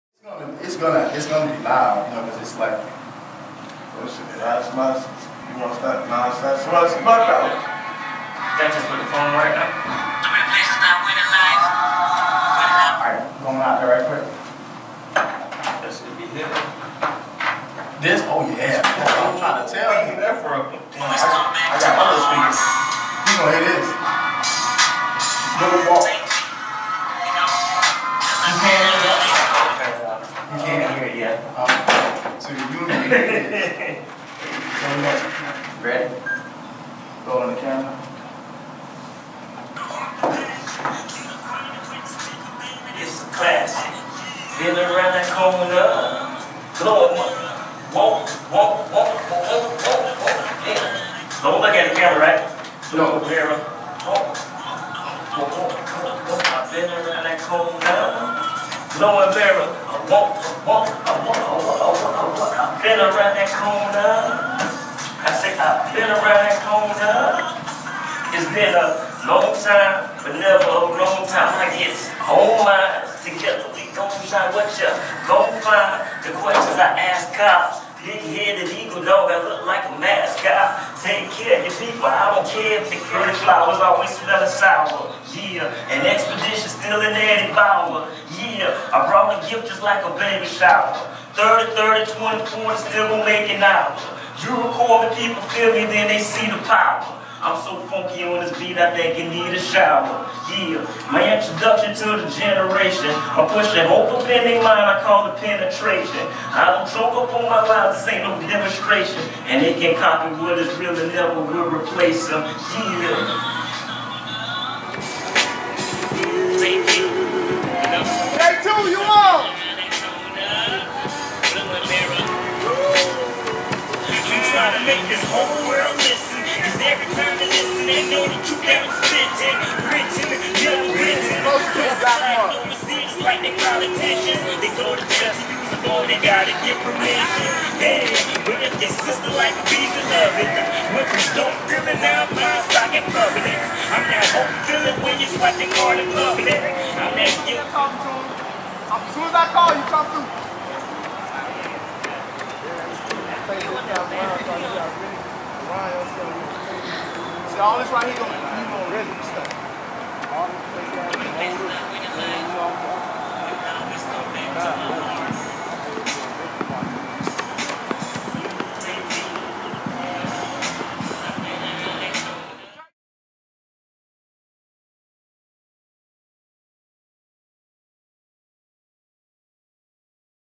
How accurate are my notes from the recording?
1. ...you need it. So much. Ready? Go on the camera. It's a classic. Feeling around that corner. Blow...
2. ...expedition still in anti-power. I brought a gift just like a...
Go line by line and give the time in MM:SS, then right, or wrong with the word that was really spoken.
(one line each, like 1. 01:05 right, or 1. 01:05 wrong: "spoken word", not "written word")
1. 00:32 right
2. 01:26 right.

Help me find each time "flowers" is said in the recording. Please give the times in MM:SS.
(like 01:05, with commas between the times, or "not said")
01:23.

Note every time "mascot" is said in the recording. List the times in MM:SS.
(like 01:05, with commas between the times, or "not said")
01:20.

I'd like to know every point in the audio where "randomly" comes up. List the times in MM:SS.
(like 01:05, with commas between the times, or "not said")
not said.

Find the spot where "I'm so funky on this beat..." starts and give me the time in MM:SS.
01:37.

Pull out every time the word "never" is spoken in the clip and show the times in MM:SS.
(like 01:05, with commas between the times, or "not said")
01:10, 01:51.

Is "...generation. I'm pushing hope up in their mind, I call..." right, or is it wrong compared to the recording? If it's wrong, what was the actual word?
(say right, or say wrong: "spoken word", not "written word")
right.